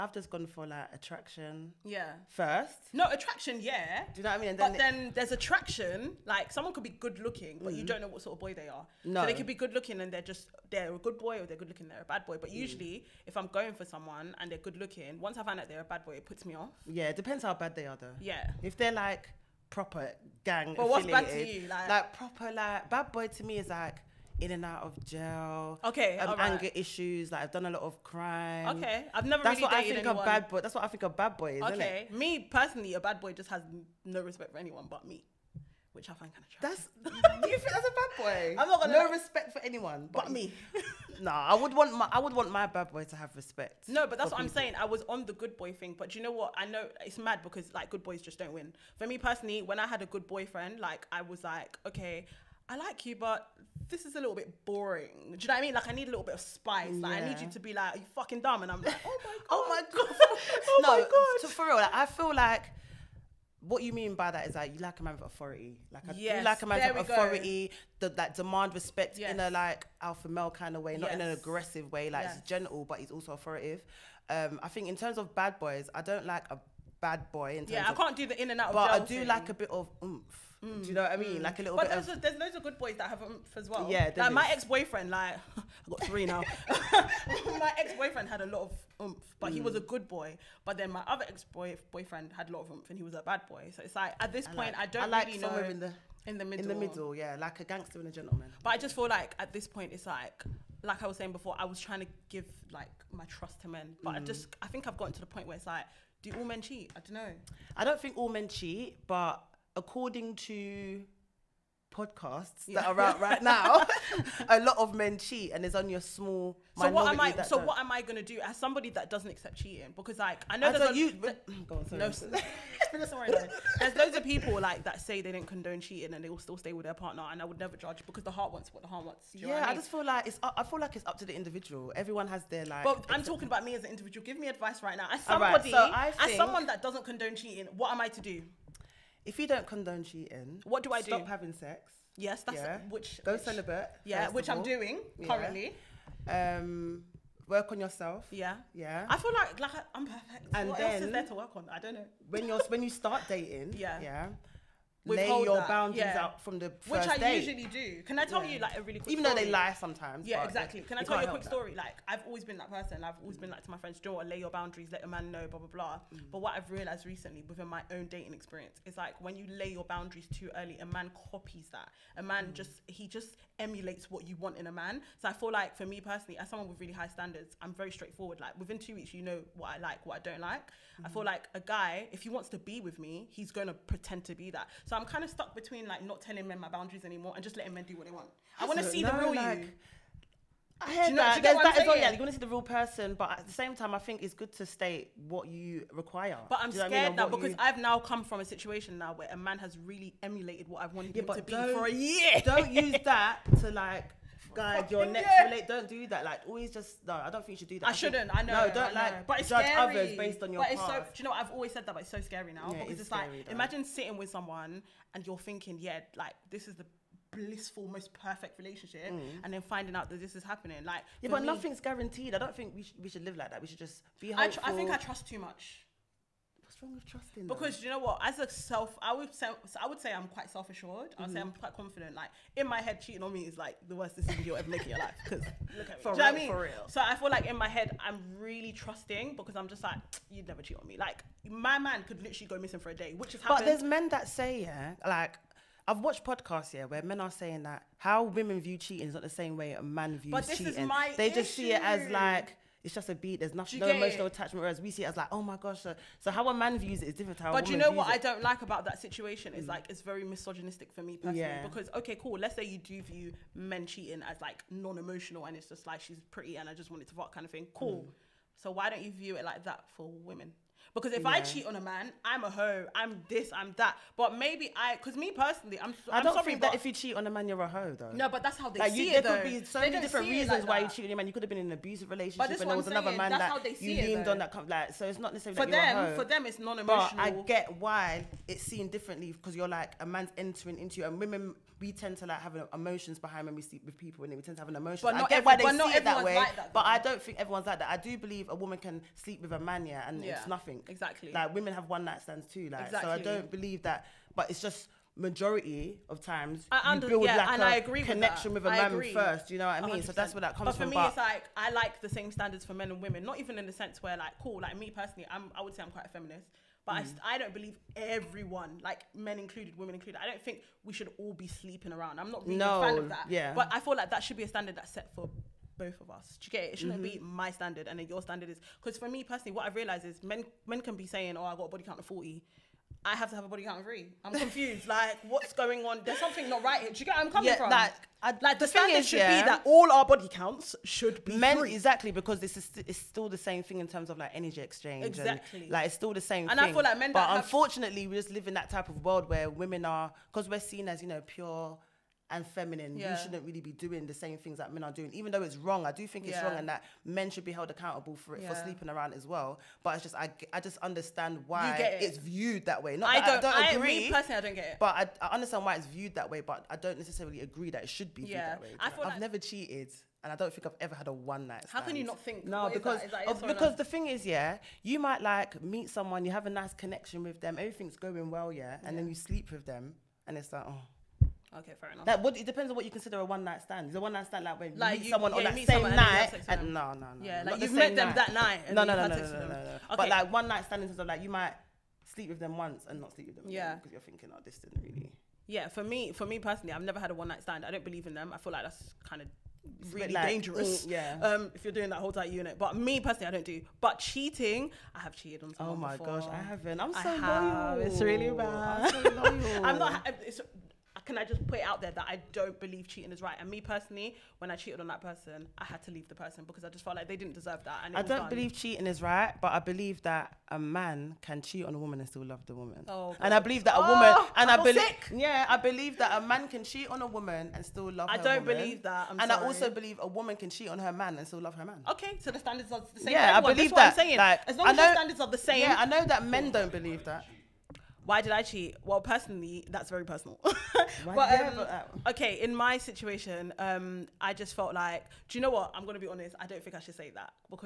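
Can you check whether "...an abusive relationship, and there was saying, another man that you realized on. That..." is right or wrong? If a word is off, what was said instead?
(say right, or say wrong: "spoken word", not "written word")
wrong: "leaned", not "realized".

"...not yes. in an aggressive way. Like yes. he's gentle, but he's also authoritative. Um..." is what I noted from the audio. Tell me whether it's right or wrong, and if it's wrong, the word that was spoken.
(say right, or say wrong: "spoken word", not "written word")
right.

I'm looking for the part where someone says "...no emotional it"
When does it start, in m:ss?
4:13.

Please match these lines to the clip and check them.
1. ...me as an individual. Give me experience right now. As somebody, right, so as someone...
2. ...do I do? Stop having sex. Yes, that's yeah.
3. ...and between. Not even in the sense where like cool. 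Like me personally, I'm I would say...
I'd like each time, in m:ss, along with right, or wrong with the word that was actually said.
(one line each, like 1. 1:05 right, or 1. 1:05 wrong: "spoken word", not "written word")
1. 2:13 wrong: "advice", not "experience"
2. 2:20 right
3. 5:12 wrong: "women", not "between".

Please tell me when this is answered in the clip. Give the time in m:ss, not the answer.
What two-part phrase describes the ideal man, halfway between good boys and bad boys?
1:37.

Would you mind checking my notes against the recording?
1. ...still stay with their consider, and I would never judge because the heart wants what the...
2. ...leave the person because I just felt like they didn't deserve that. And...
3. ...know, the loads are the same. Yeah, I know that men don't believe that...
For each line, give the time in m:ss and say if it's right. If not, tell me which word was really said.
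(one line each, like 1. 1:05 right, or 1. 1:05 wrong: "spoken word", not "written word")
1. 2:06 wrong: "partner", not "consider"
2. 6:55 right
3. 7:14 wrong: "standards", not "loads".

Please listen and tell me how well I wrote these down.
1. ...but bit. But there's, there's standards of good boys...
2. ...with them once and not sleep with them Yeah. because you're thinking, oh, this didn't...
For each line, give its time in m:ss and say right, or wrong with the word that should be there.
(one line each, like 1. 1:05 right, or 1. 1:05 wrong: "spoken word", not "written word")
1. 1:21 wrong: "loads", not "standards"
2. 6:32 right.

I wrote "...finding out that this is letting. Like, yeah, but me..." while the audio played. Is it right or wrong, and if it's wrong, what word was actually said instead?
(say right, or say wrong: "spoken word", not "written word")
wrong: "happening", not "letting".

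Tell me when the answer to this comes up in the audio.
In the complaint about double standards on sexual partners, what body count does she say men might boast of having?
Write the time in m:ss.
5:32.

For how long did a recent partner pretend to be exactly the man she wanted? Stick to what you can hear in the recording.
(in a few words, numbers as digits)
a year.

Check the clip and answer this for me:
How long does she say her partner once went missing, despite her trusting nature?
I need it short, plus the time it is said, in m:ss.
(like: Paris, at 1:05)
a day, at 4:02.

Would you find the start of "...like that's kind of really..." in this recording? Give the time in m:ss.
6:38.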